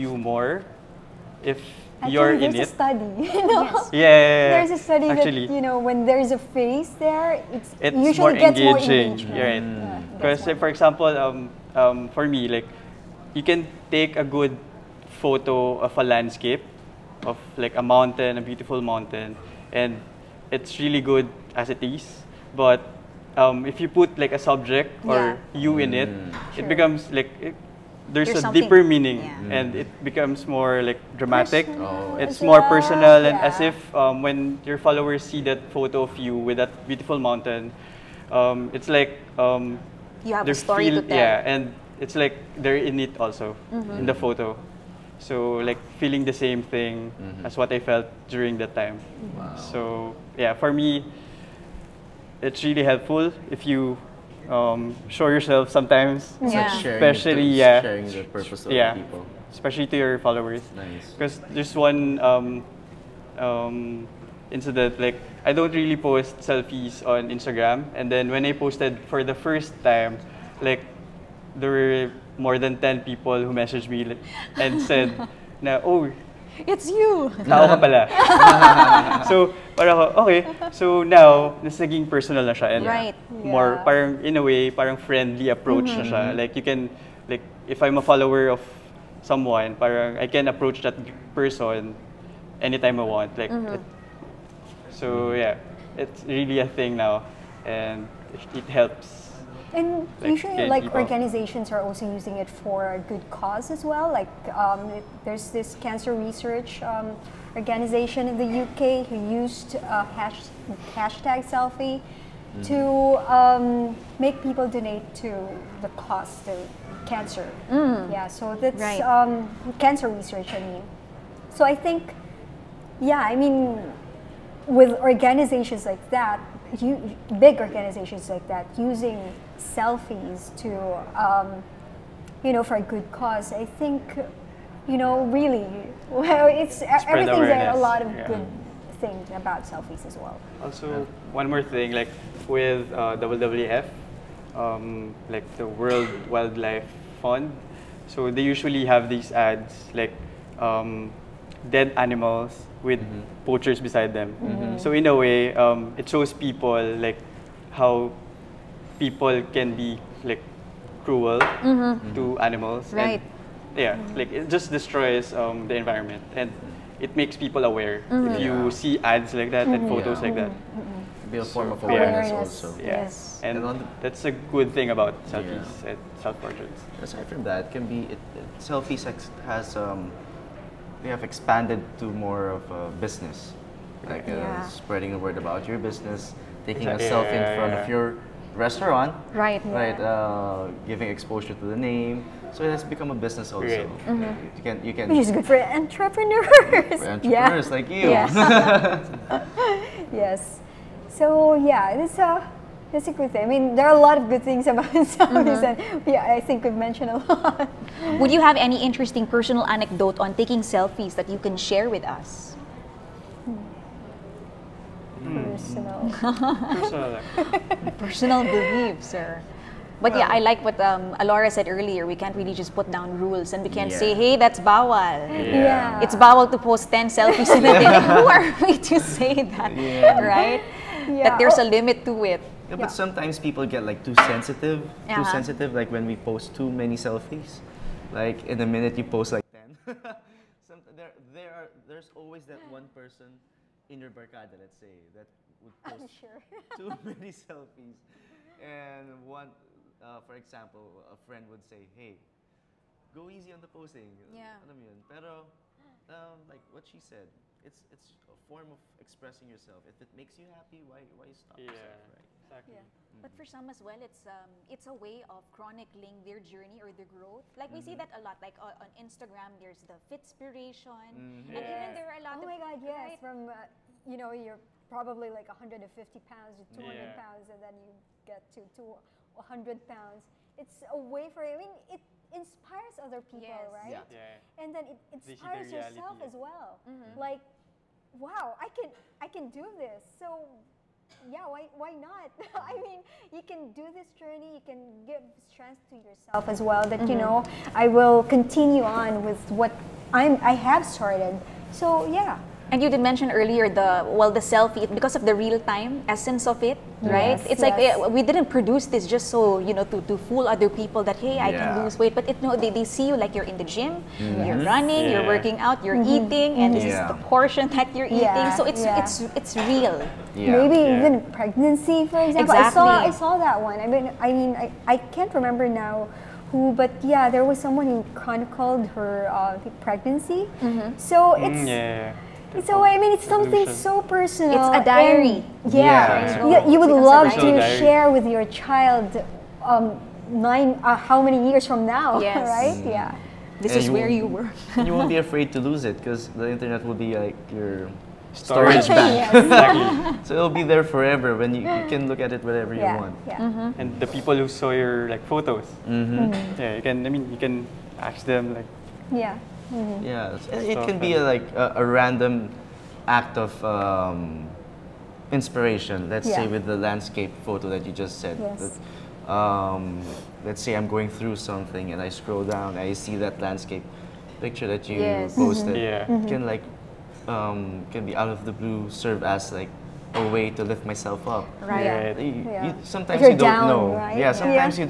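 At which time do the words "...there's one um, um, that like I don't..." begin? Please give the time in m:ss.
1:01.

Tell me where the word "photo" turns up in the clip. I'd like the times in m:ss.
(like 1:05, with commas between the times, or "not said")
0:15, 0:35, 0:44, 2:49, 5:55, 6:07.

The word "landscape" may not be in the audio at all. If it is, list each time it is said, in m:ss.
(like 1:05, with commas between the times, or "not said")
0:16, 6:06, 6:13.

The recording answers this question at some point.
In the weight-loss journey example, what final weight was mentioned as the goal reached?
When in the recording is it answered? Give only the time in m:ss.
4:39.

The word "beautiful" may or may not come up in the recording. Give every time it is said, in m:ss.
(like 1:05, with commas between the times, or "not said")
0:18, 0:36.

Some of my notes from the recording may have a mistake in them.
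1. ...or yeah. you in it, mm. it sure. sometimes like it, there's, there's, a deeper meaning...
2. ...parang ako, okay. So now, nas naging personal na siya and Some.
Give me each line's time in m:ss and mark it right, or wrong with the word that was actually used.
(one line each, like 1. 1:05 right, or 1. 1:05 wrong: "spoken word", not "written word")
1. 0:25 wrong: "becomes", not "sometimes"
2. 1:19 wrong: "Right", not "Some".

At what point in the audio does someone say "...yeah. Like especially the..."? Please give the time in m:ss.
0:56.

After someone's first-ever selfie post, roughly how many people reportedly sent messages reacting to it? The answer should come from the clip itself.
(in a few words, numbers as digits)
more than 10.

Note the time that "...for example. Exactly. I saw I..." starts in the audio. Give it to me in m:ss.
5:22.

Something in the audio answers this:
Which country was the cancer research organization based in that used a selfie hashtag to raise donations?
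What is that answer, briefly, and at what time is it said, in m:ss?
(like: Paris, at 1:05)
UK, at 1:48.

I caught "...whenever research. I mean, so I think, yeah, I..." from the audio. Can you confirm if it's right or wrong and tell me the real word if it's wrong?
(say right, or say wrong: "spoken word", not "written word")
wrong: "cancer", not "whenever".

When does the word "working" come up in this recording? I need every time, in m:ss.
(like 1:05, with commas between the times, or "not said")
5:15.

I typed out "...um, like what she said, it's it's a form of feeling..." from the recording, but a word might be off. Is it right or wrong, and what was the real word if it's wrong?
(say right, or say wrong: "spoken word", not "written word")
wrong: "expressing", not "feeling".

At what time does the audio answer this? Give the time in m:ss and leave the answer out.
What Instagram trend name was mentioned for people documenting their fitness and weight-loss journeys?
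4:30.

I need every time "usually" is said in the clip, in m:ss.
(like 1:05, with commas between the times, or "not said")
0:07, 1:40, 2:28.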